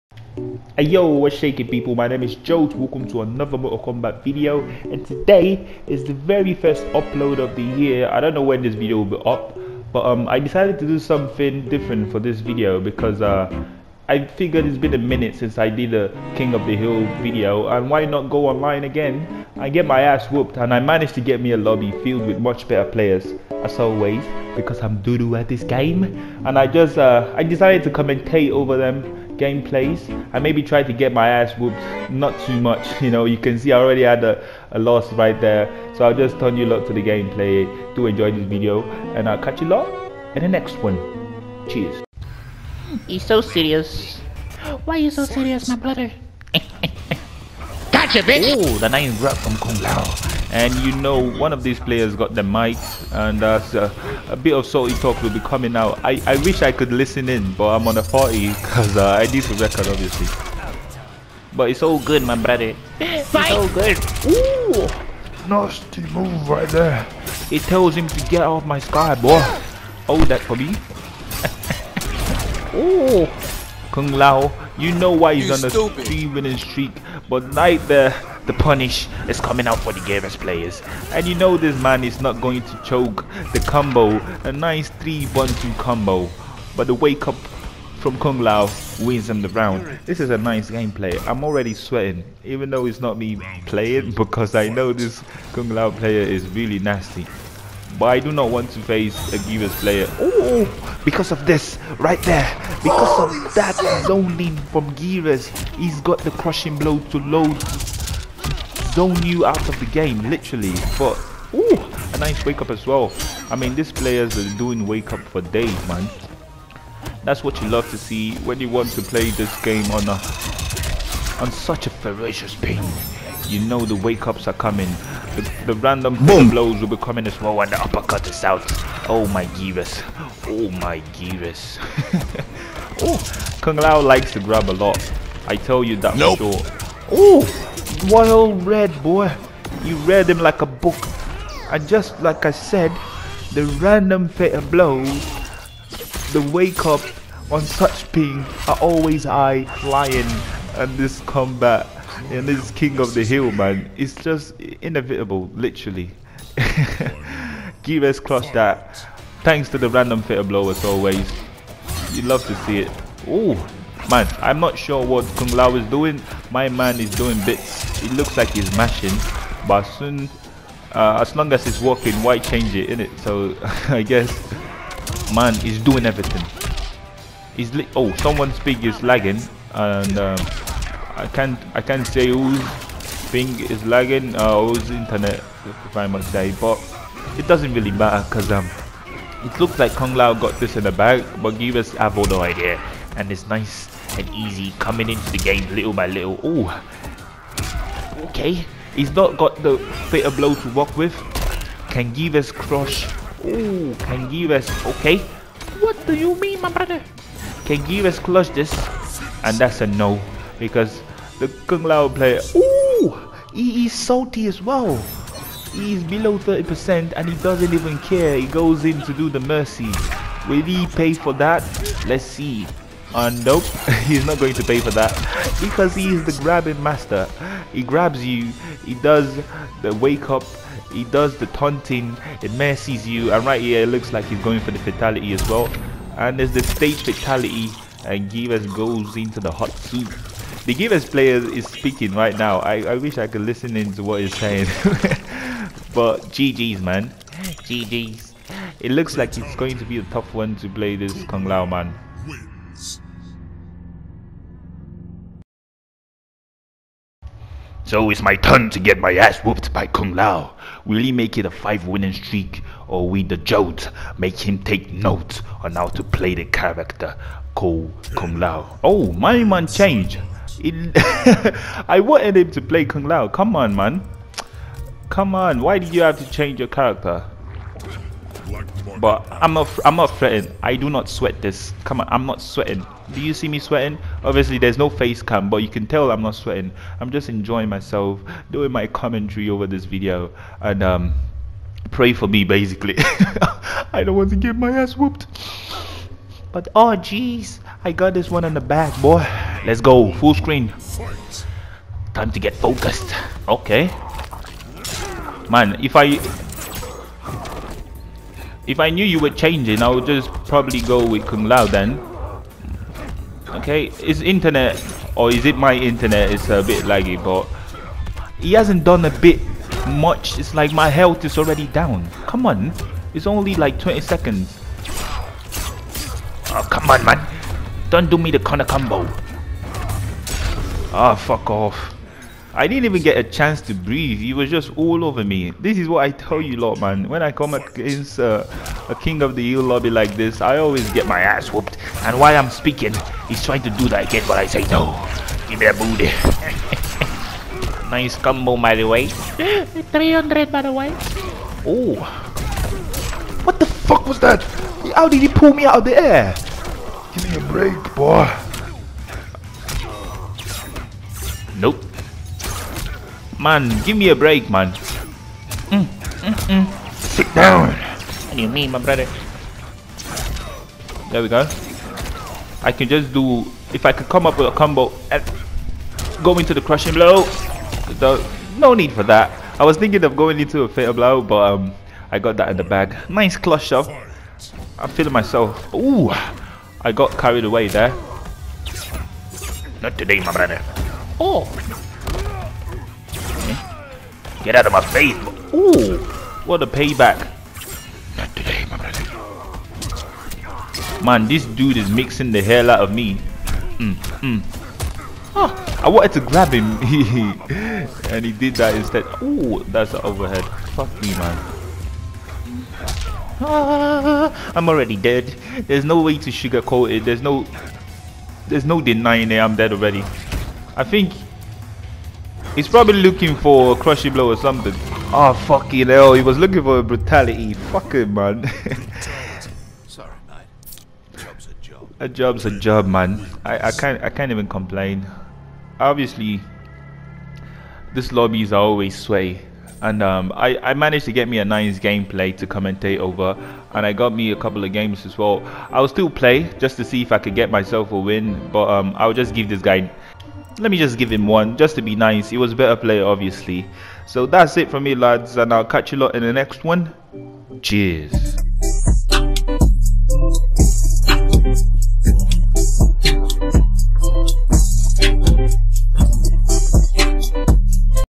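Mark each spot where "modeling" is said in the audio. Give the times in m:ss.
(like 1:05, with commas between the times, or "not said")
not said.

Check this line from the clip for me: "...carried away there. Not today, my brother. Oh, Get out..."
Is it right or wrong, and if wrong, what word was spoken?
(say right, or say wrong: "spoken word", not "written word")
right.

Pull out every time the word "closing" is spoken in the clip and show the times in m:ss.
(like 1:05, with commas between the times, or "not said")
not said.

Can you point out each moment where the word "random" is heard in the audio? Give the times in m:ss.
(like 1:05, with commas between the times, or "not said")
2:05, 2:23, 2:39.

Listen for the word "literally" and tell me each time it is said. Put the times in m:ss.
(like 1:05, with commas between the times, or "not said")
1:50, 2:35.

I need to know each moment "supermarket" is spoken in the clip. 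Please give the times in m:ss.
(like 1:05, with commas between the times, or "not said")
not said.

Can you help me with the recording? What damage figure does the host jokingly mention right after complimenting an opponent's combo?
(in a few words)
300.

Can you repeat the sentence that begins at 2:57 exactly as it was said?
He's oh, someone's ping is lagging.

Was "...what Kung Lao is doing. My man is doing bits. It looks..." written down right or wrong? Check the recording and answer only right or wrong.
right.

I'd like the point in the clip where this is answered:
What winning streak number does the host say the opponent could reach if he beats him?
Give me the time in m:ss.
4:21.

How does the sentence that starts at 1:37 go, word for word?
But I do not want to face a Geras player.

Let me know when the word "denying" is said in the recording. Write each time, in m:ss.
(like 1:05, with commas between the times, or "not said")
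6:58.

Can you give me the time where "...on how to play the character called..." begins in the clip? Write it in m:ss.
4:25.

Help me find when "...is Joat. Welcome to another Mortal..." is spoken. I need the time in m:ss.
0:02.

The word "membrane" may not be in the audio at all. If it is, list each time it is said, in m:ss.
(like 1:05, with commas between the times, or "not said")
not said.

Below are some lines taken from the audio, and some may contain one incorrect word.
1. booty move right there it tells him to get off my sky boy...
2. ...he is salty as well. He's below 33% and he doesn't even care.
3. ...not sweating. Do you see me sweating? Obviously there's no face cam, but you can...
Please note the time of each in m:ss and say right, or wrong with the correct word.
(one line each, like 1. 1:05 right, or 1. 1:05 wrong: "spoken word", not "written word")
1. 1:05 wrong: "nasty", not "booty"
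2. 3:33 wrong: "30", not "33"
3. 4:42 right.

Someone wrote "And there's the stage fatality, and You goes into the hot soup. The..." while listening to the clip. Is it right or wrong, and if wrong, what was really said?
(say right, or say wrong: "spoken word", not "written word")
wrong: "Geras", not "You".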